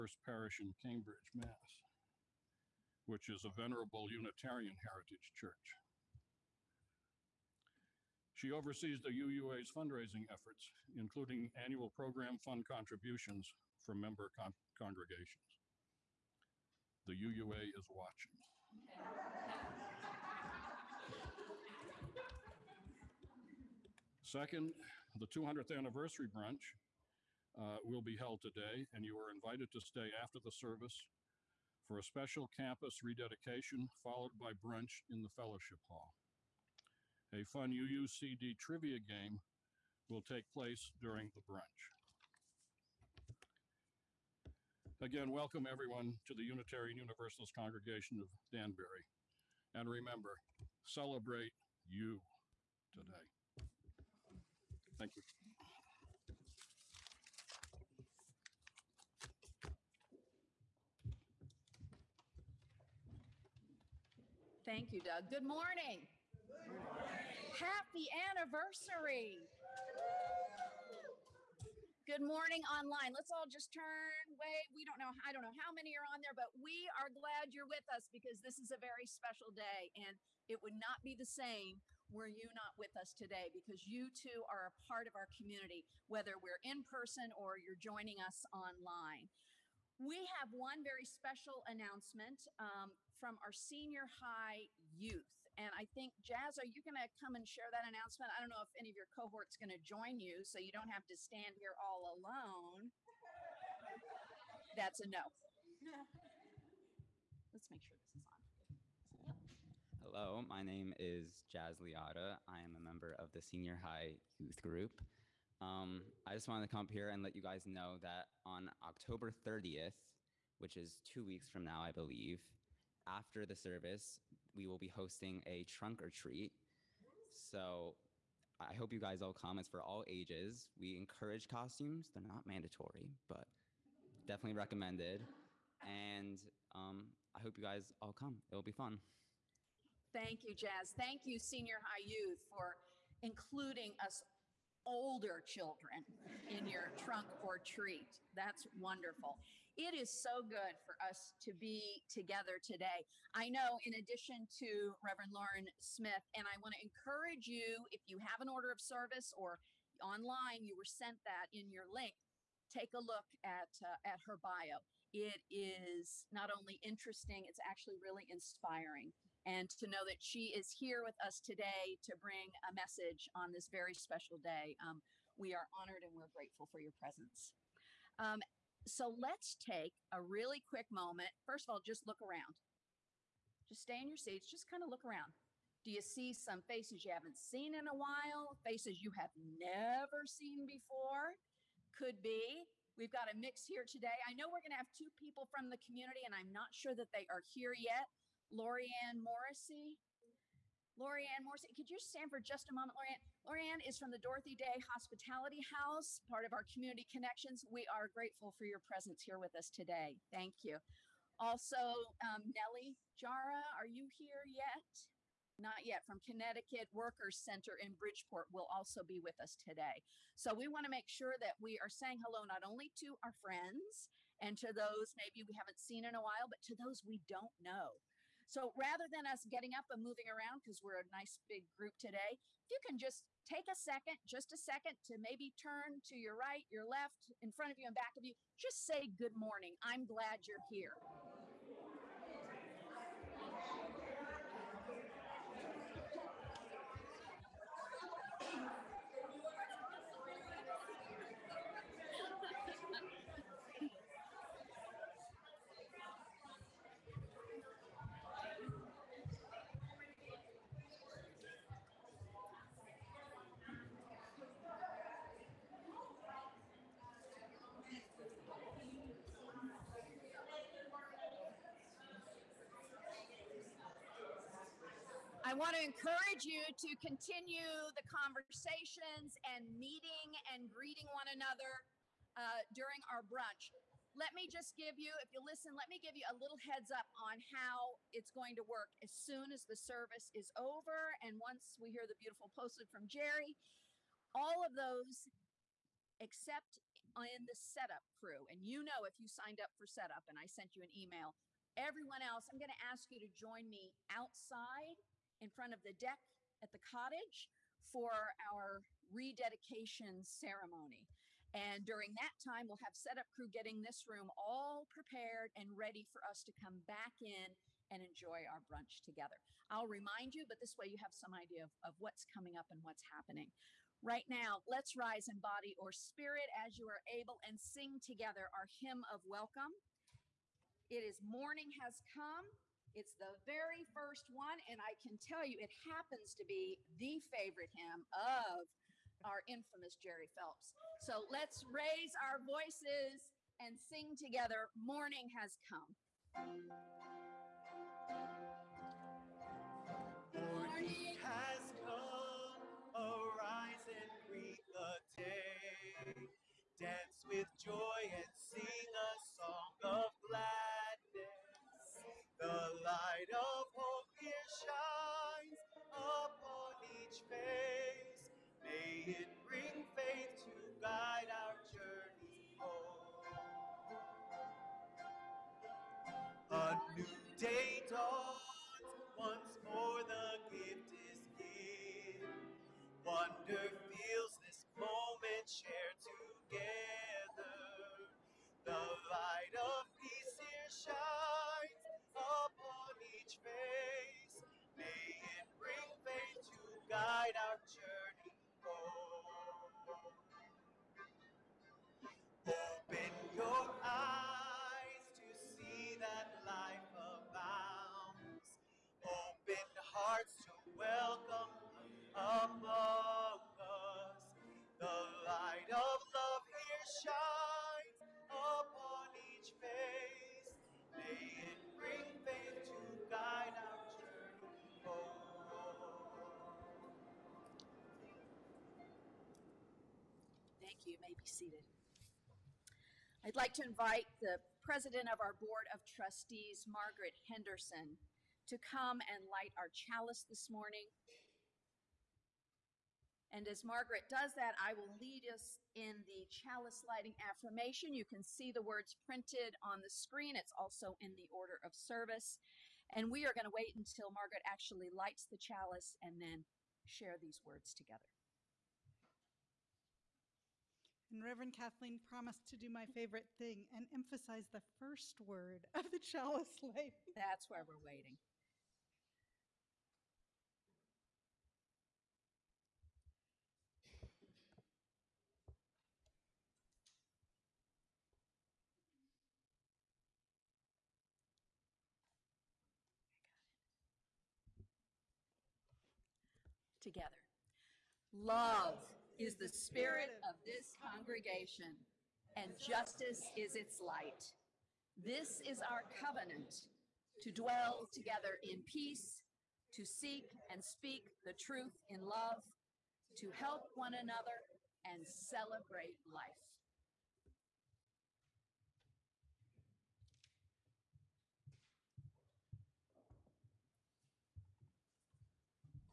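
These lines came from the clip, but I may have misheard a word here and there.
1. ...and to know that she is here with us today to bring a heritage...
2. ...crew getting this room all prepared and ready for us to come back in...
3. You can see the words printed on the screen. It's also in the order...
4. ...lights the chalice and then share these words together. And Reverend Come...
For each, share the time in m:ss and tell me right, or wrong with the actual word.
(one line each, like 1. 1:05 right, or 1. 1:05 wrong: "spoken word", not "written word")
1. 2:49 wrong: "message", not "heritage"
2. 5:13 right
3. 7:27 right
4. 7:34 wrong: "Kathleen", not "Come".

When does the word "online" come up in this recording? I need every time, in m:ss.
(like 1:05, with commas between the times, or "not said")
1:12, 1:28, 2:40.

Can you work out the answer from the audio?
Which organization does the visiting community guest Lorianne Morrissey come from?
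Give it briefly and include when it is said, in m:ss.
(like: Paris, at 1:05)
Dorothy Day Hospitality House, at 3:24.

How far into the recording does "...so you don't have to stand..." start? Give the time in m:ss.
1:40.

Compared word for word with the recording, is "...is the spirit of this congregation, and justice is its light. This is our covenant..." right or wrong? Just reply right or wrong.
right.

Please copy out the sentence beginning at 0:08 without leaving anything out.
She oversees the UUA's fundraising efforts, including annual program fund contributions from member con- congregations.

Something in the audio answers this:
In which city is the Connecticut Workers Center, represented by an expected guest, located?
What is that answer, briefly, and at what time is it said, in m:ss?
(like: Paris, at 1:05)
Bridgeport, at 3:37.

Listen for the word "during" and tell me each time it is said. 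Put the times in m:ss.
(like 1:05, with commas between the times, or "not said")
0:40, 4:42, 5:11.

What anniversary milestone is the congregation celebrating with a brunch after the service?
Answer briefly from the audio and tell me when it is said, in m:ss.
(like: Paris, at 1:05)
200th, at 0:25.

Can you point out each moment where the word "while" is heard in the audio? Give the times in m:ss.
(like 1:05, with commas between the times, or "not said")
3:07, 3:46.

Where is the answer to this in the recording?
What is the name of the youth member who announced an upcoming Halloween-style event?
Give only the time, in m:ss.
1:51.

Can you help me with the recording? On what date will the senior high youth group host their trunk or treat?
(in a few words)
October 30th.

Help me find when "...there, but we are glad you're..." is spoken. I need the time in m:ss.
1:16.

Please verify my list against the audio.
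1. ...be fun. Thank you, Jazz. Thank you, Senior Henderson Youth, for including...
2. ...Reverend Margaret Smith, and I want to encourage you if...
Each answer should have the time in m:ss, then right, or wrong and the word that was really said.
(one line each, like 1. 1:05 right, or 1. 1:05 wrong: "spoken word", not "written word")
1. 2:18 wrong: "High", not "Henderson"
2. 2:35 wrong: "Lauren", not "Margaret".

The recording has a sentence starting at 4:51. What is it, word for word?
And once we hear the beautiful postlude from Jerry, all of those except in the setup crew.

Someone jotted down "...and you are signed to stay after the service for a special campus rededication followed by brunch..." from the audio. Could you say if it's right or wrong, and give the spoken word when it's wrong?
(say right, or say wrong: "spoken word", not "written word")
wrong: "invited", not "signed".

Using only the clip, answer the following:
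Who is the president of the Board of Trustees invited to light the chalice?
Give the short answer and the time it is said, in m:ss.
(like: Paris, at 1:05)
Margaret Henderson, at 7:16.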